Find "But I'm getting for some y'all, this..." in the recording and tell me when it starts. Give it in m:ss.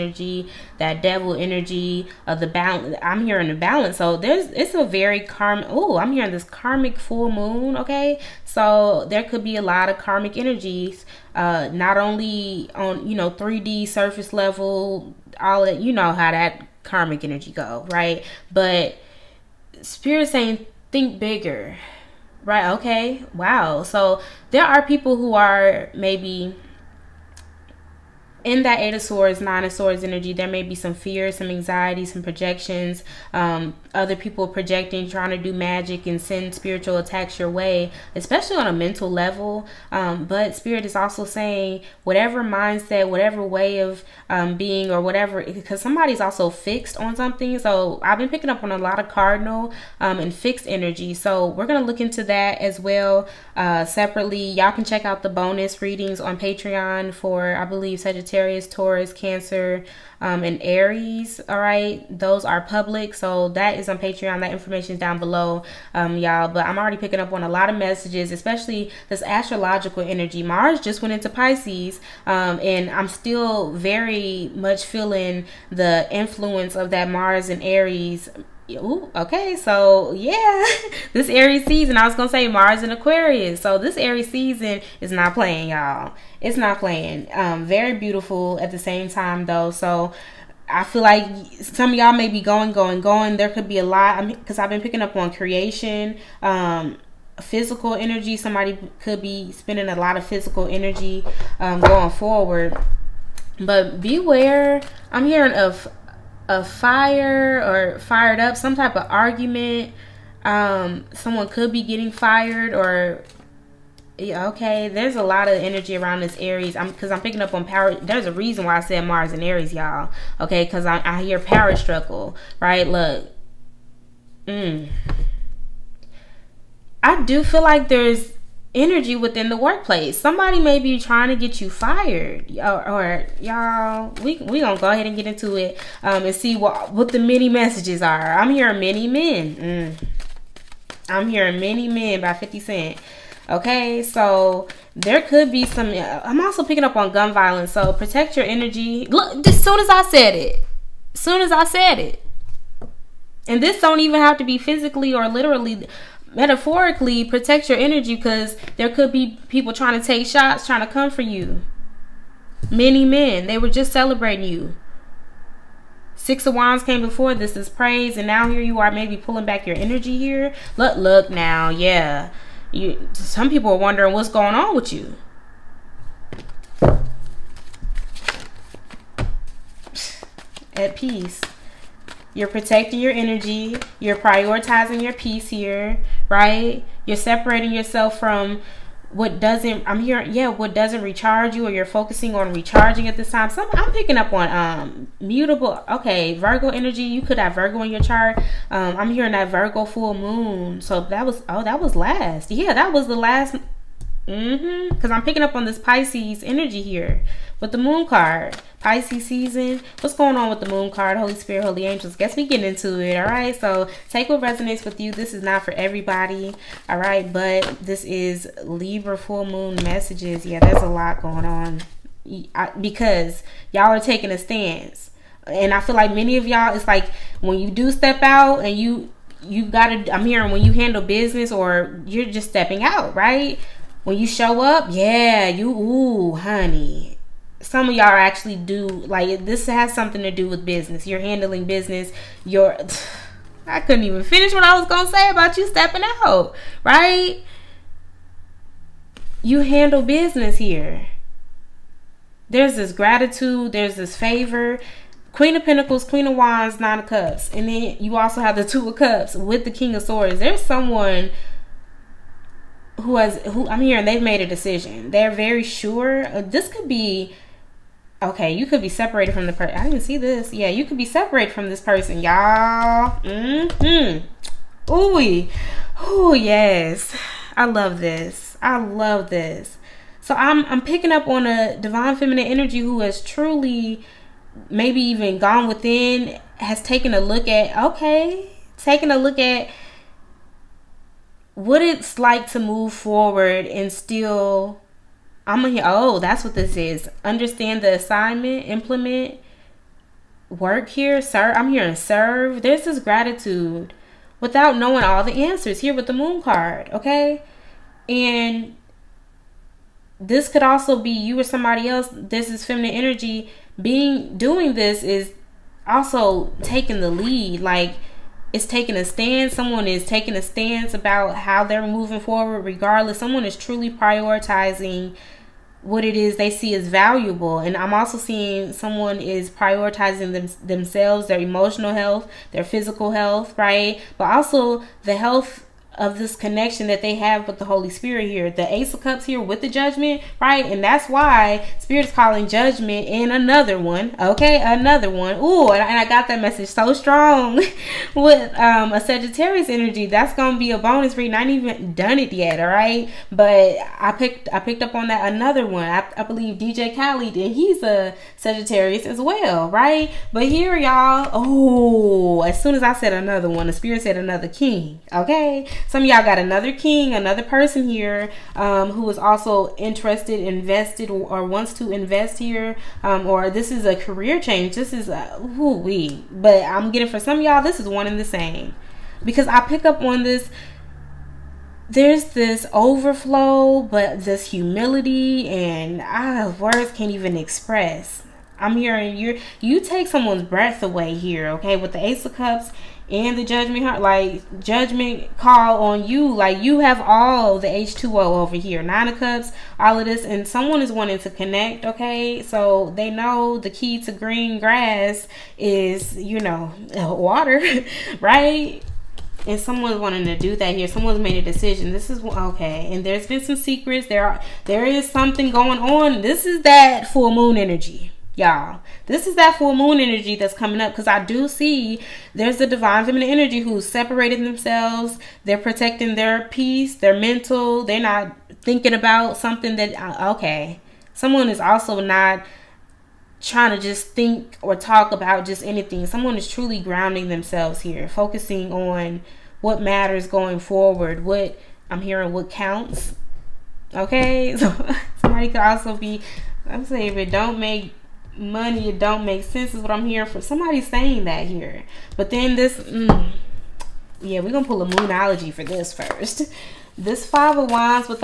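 6:16.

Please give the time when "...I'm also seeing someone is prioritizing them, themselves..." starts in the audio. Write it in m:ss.
5:27.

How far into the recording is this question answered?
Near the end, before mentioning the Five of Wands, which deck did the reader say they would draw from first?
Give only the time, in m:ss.
7:34.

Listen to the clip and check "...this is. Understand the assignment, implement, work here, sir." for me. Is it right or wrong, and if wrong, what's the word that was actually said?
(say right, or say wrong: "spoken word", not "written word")
right.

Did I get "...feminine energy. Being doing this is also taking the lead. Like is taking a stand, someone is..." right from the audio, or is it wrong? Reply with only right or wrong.
right.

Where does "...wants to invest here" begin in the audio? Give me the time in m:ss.
6:11.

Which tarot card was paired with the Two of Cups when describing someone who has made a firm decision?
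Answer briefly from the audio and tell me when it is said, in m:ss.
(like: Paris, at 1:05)
King of Swords, at 4:19.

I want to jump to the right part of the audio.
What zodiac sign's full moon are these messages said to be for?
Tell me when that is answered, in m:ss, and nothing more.
3:38.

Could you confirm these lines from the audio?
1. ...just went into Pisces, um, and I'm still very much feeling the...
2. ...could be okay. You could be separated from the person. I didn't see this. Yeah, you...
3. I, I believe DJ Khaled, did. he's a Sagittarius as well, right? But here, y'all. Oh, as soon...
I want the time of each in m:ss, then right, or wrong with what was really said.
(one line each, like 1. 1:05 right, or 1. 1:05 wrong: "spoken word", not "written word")
1. 1:10 right
2. 4:26 right
3. 5:55 right.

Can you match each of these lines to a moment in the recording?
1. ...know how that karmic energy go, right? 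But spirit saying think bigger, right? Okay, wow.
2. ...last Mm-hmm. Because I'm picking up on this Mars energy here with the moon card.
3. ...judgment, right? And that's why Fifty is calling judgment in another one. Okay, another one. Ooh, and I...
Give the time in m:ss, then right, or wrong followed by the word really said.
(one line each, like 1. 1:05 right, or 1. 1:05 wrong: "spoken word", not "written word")
1. 0:15 right
2. 3:23 wrong: "Pisces", not "Mars"
3. 5:39 wrong: "Spirit", not "Fifty".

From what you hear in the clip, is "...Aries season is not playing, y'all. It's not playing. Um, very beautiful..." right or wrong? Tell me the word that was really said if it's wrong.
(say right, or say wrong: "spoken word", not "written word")
right.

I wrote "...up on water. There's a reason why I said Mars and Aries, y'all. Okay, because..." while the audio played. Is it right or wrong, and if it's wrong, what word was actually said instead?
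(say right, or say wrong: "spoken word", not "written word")
wrong: "power", not "water".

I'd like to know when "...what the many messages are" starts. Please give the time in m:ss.
2:16.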